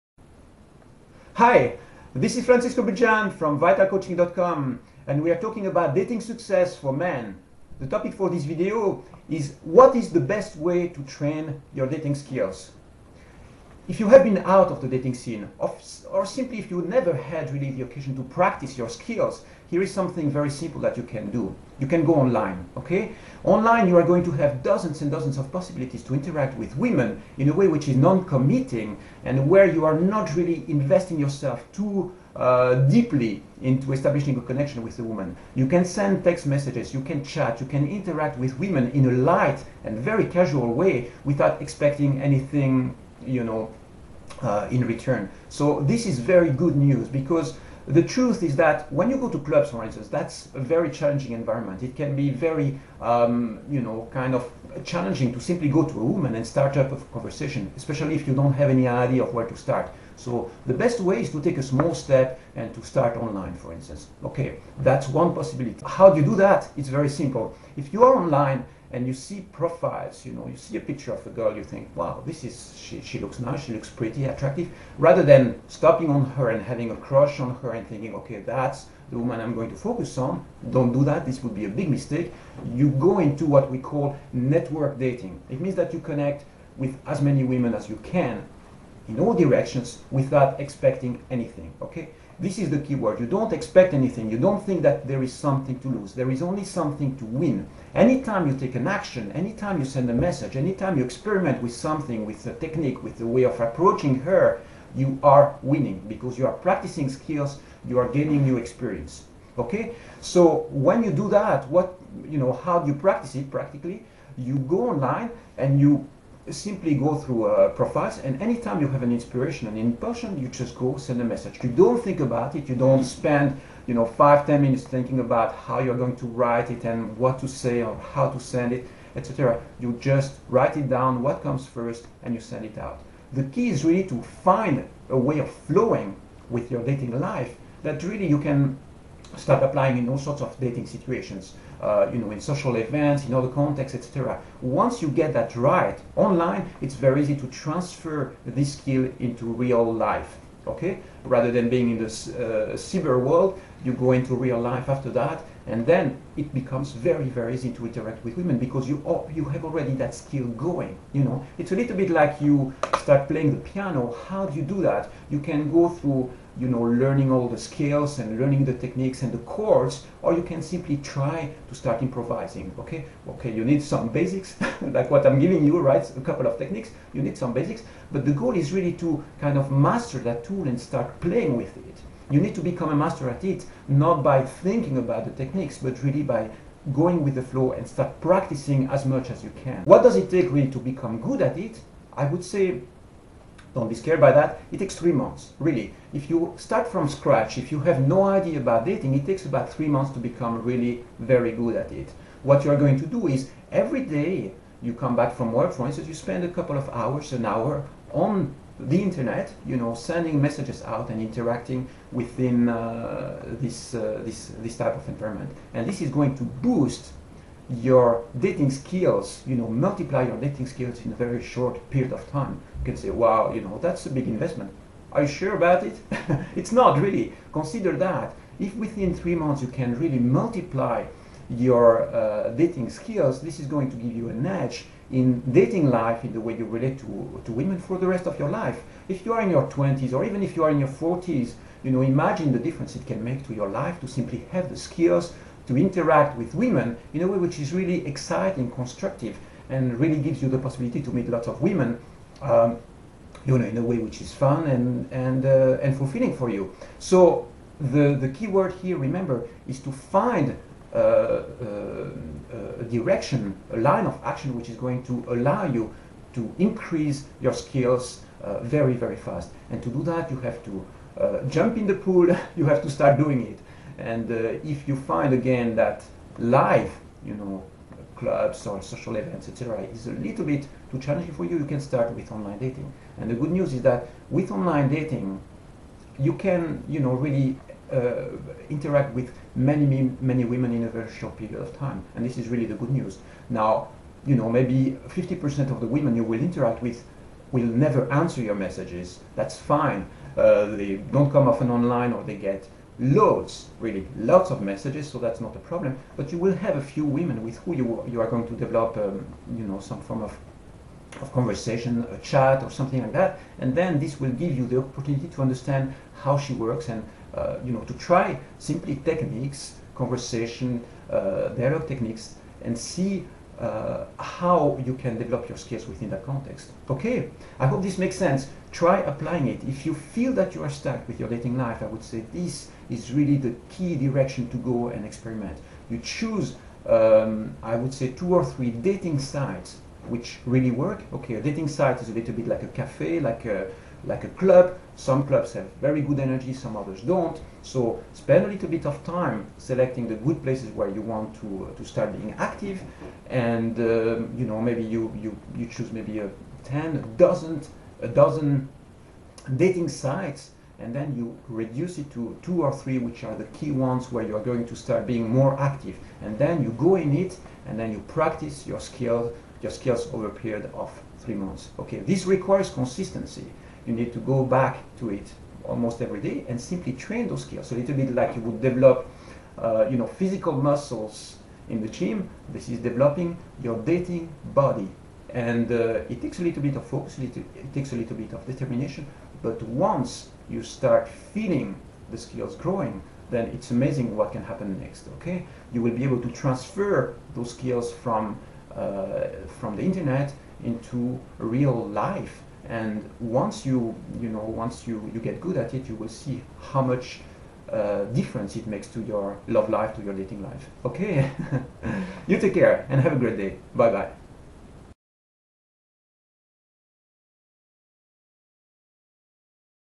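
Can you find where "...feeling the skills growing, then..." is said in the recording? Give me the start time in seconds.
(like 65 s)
391 s.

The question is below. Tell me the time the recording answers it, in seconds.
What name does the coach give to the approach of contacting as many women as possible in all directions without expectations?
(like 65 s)
84 s.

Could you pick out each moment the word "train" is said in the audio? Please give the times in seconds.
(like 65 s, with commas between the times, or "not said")
11 s, 376 s.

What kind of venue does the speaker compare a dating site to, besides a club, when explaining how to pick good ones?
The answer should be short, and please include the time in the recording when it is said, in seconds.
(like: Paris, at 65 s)
a cafe, at 342 s.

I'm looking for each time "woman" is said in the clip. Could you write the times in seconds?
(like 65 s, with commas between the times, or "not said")
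35 s, 56 s, 79 s.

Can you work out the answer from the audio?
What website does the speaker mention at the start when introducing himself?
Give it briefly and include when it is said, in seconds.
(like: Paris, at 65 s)
vitalcoaching.com, at 3 s.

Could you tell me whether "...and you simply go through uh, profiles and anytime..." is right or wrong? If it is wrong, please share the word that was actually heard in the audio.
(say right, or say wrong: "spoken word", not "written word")
right.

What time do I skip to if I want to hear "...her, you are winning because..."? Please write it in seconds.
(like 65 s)
104 s.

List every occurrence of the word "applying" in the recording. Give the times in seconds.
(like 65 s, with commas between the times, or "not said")
139 s, 329 s.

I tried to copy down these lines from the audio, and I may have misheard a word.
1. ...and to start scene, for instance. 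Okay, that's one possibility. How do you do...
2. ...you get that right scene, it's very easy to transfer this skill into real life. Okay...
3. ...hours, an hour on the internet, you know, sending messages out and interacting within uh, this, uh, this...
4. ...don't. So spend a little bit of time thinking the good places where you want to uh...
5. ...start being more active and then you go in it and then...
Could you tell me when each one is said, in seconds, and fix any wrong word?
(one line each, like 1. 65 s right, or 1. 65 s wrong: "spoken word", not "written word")
1. 62 s wrong: "online", not "scene"
2. 145 s wrong: "online", not "scene"
3. 206 s right
4. 347 s wrong: "selecting", not "thinking"
5. 364 s right.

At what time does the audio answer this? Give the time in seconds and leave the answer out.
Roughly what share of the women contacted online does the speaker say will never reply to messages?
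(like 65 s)
295 s.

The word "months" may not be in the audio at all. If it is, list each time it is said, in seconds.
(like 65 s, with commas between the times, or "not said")
195 s, 199 s, 229 s, 371 s.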